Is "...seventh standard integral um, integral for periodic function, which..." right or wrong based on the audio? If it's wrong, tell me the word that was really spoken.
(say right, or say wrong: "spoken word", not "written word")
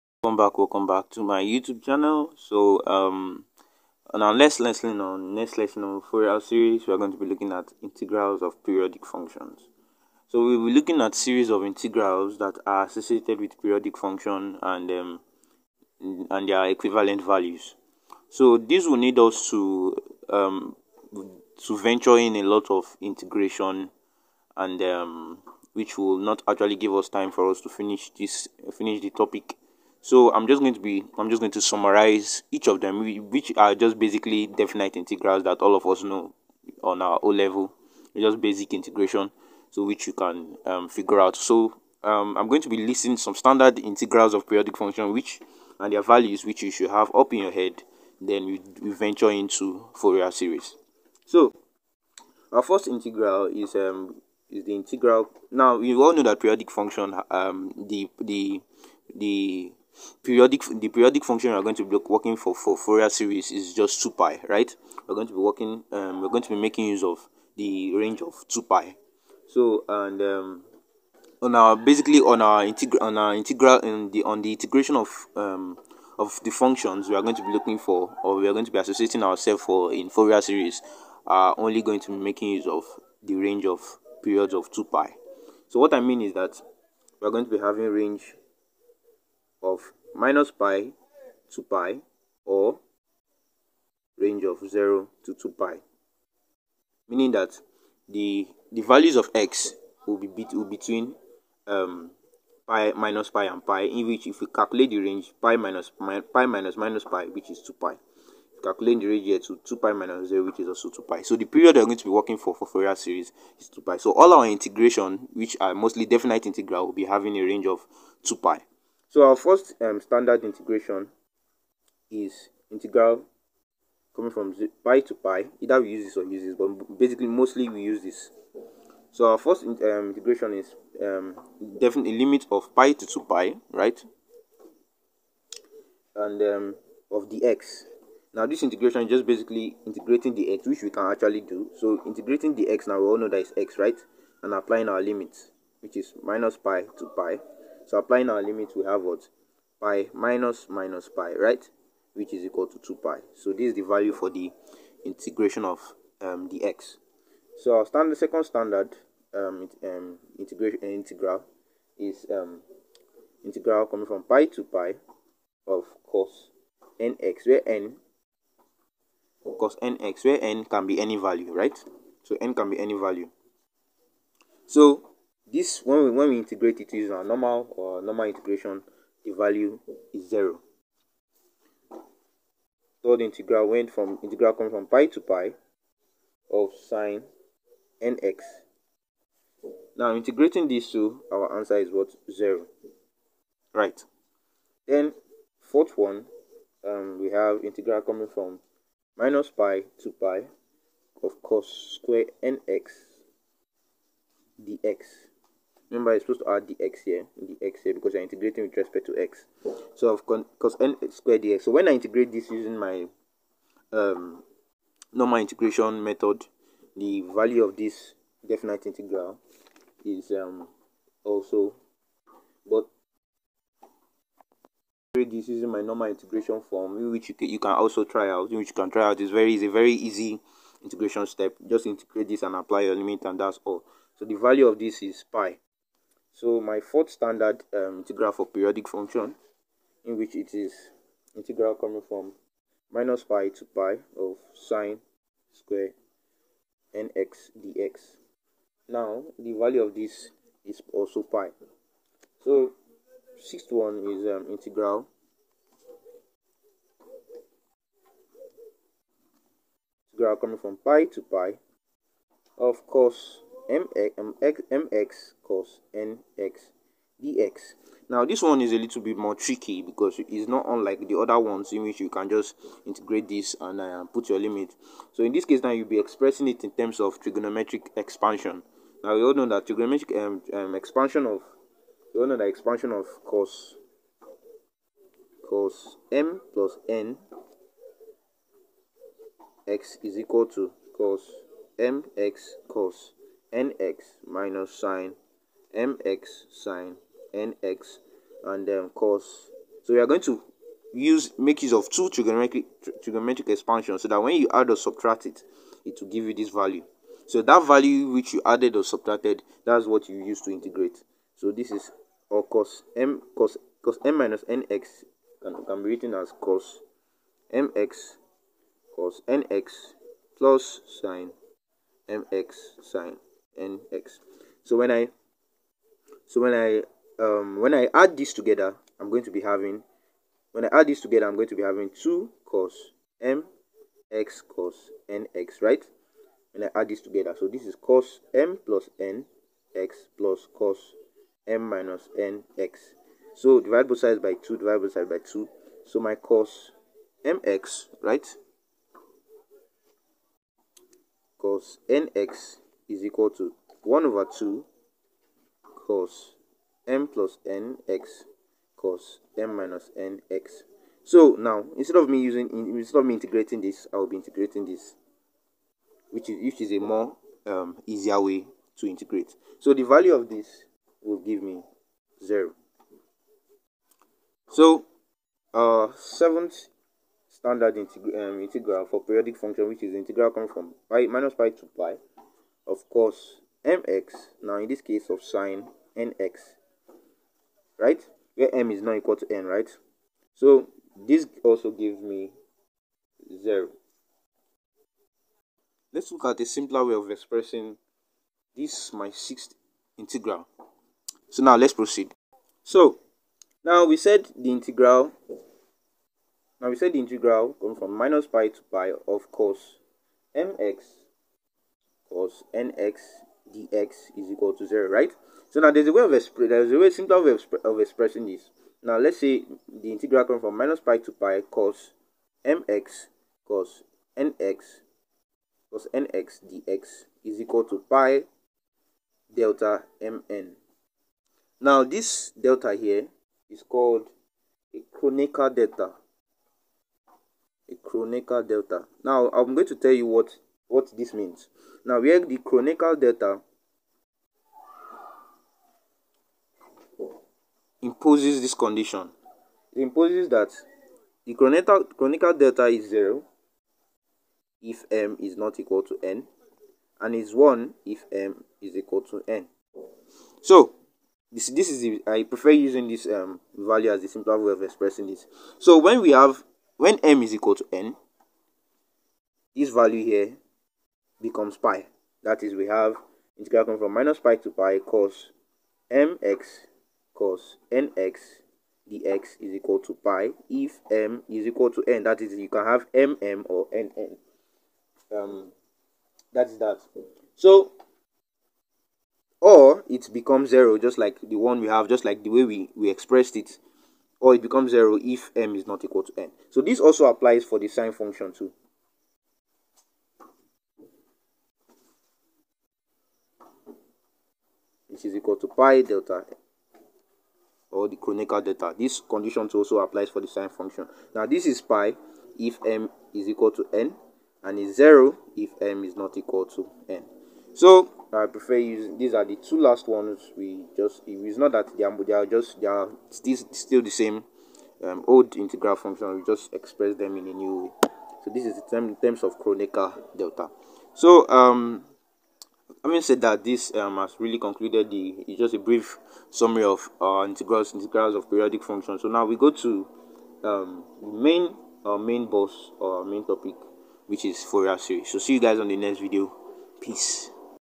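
right.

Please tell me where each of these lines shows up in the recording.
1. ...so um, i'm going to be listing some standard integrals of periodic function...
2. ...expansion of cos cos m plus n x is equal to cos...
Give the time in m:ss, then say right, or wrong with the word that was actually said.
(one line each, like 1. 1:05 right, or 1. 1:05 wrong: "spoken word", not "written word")
1. 0:41 right
2. 4:42 right.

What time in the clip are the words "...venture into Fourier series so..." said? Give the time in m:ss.
0:48.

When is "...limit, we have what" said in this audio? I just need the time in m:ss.
2:28.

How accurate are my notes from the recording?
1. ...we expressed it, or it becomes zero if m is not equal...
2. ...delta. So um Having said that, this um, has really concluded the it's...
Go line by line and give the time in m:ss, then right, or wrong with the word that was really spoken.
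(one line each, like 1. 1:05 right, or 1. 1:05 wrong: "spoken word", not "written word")
1. 8:12 right
2. 8:50 right.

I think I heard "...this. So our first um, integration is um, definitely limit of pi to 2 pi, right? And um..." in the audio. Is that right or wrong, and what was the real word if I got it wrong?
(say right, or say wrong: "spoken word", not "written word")
right.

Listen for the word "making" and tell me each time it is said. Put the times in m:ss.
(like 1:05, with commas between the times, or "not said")
1:06, 1:22.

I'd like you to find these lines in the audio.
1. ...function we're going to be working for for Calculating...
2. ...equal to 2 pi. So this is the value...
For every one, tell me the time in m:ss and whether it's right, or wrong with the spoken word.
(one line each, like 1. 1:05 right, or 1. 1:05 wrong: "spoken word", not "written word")
1. 1:01 wrong: "Fourier", not "Calculating"
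2. 2:32 right.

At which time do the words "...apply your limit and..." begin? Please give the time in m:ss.
3:52.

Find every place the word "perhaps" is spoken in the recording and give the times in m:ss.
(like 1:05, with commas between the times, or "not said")
not said.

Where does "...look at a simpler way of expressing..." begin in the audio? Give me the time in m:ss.
6:36.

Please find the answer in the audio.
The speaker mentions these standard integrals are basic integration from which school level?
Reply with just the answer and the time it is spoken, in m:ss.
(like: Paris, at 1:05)
O level, at 0:37.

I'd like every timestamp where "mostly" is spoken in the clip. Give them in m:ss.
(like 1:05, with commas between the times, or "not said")
1:55, 2:07.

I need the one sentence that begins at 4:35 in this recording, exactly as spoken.
So in this case now you'll be expressing it in terms of trigonometric expansion.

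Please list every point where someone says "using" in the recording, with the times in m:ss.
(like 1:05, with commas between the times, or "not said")
2:56, 3:32, 3:45, 6:02, 7:42, 8:38.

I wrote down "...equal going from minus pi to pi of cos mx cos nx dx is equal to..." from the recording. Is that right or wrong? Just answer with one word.
wrong.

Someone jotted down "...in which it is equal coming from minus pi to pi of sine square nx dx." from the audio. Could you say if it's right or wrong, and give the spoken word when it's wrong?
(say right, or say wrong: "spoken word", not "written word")
wrong: "integral", not "equal".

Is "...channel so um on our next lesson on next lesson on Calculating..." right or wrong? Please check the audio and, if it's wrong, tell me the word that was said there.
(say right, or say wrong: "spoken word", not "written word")
wrong: "Fourier", not "Calculating".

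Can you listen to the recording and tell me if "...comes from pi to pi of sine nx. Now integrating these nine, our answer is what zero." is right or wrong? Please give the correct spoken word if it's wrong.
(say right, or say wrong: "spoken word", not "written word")
wrong: "two", not "nine".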